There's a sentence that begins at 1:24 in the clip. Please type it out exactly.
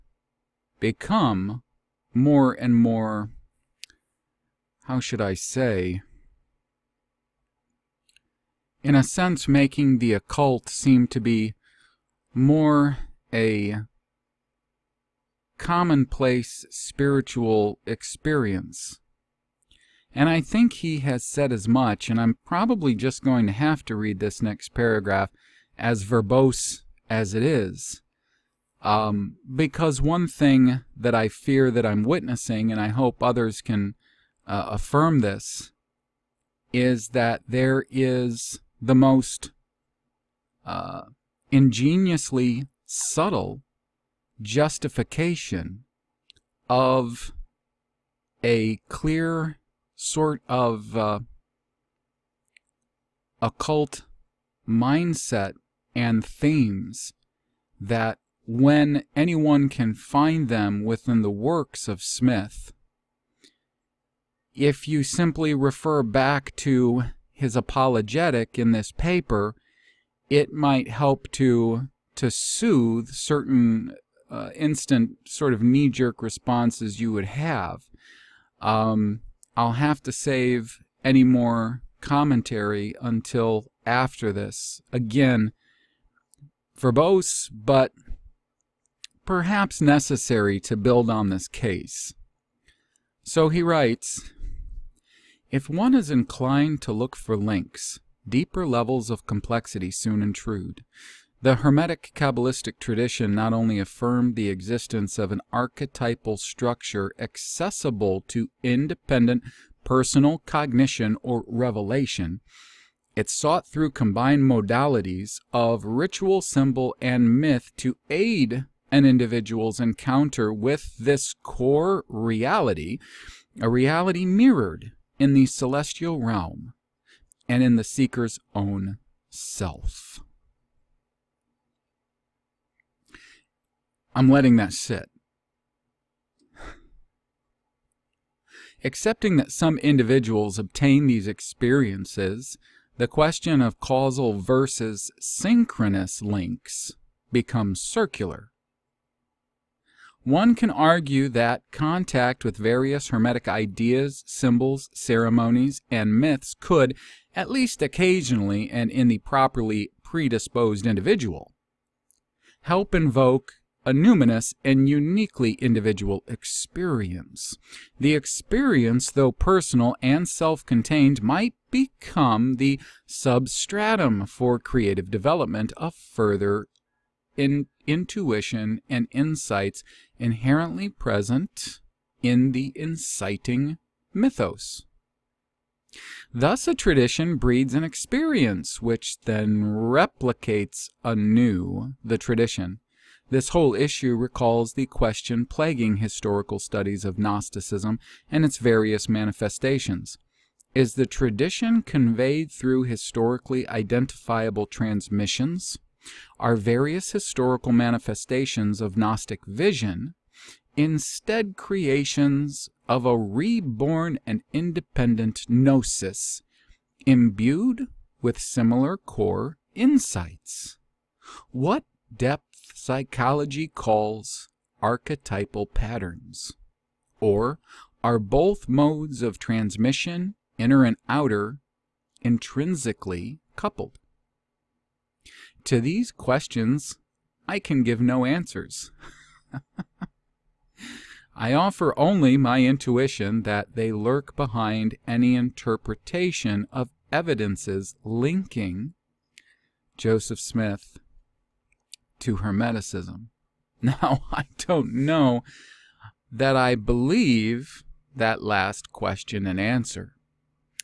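Again, verbose, but perhaps necessary to build on this case.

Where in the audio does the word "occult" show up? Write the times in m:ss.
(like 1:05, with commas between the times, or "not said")
0:10, 0:53.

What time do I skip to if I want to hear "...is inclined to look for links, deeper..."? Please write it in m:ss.
1:35.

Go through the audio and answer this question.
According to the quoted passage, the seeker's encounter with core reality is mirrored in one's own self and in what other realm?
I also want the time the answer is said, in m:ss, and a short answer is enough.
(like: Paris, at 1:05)
the celestial realm, at 2:05.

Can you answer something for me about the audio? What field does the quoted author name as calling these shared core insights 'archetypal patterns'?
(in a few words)
depth psychology.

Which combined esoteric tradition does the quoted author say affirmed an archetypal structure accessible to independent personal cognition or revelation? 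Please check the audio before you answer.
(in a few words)
Hermetic Kabbalistic tradition.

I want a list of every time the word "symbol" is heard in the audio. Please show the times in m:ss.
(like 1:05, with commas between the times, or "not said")
1:56, 2:34.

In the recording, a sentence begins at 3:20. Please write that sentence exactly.
Is the tradition conveyed through historically identifiable transmissions?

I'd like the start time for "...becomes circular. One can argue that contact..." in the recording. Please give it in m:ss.
2:27.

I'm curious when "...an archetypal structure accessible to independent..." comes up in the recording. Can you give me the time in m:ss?
1:45.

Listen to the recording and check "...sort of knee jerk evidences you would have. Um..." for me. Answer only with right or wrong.
wrong.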